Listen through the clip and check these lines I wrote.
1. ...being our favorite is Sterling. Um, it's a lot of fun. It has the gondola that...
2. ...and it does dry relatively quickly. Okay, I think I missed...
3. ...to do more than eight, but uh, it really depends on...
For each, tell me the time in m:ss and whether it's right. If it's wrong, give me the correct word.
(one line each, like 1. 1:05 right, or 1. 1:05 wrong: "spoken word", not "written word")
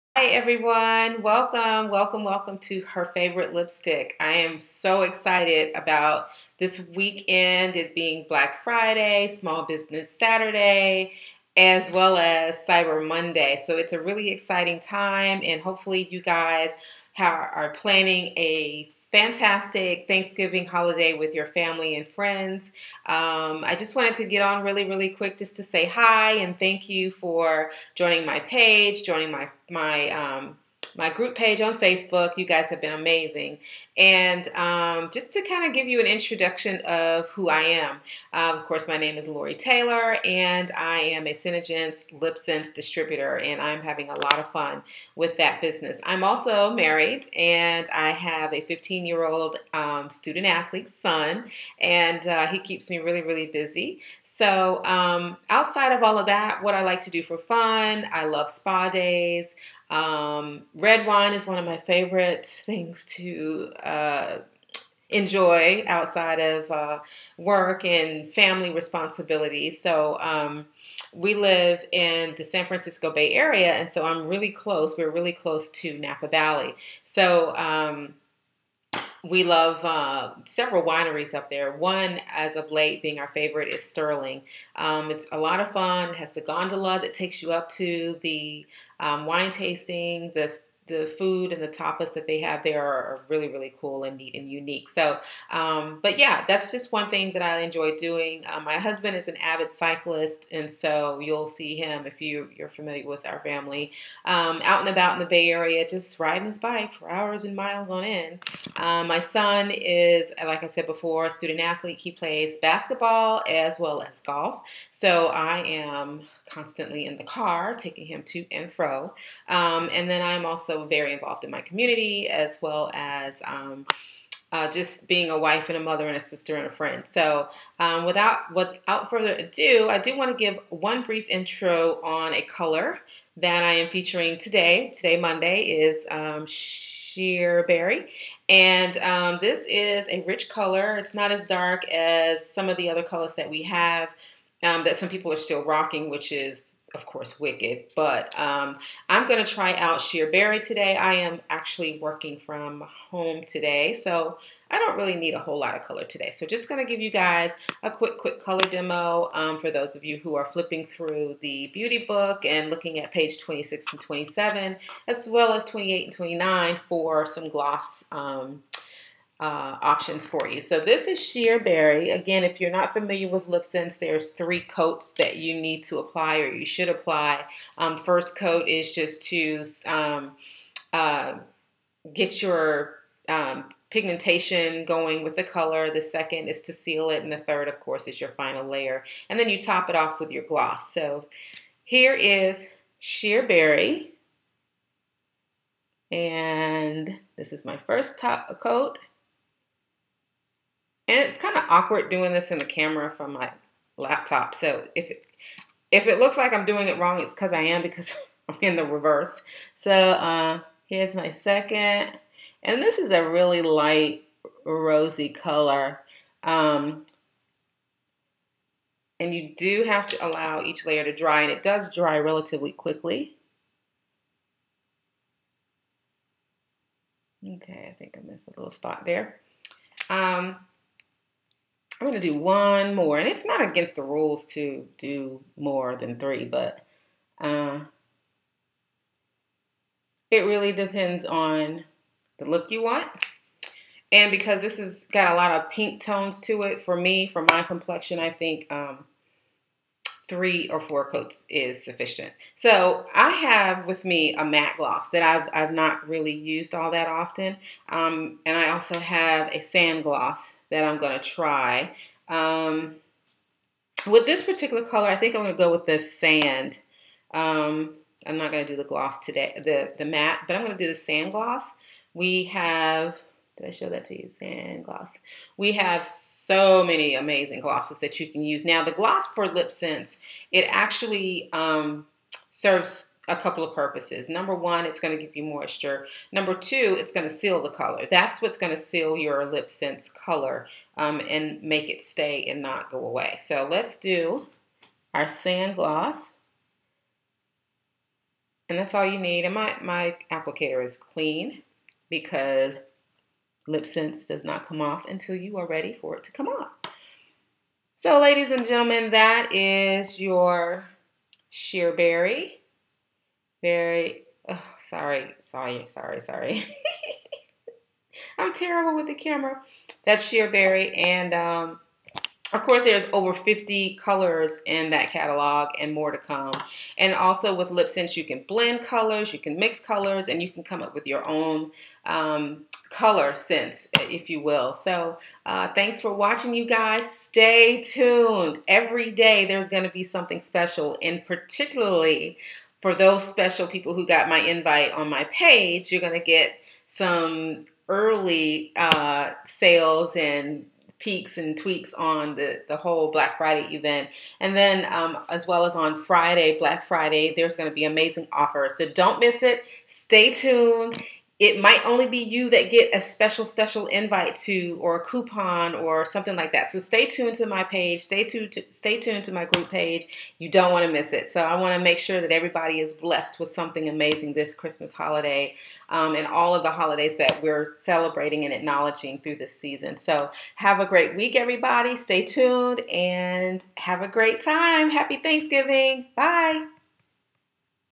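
1. 1:23 right
2. 3:41 right
3. 3:54 wrong: "three", not "eight".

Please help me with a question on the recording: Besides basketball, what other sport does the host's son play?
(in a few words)
golf.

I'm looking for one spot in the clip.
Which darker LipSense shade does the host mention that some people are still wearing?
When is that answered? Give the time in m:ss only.
2:27.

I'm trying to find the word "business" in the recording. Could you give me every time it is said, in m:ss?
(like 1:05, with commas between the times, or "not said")
0:09, 0:45.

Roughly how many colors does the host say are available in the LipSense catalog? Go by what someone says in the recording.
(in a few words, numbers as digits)
over 50.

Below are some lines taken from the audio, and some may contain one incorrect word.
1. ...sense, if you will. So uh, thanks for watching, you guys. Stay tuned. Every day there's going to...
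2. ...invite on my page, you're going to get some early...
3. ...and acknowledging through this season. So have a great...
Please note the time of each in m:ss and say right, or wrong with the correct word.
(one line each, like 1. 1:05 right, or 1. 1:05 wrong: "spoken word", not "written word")
1. 5:33 right
2. 5:44 right
3. 6:18 right.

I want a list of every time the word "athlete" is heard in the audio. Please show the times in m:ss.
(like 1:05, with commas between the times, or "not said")
0:50, 1:51.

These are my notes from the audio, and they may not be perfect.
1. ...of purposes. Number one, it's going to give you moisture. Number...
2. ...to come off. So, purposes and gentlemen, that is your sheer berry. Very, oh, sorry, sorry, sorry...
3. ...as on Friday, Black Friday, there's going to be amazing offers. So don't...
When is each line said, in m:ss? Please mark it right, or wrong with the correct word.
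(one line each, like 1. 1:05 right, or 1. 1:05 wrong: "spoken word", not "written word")
1. 4:43 right
2. 5:06 wrong: "ladies", not "purposes"
3. 5:55 right.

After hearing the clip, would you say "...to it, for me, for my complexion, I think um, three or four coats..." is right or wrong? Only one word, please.
right.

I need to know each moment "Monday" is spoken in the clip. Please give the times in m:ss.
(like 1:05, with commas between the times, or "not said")
0:13, 2:15.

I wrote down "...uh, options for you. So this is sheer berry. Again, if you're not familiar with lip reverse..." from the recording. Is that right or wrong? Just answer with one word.
wrong.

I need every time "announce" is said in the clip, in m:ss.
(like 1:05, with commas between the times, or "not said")
not said.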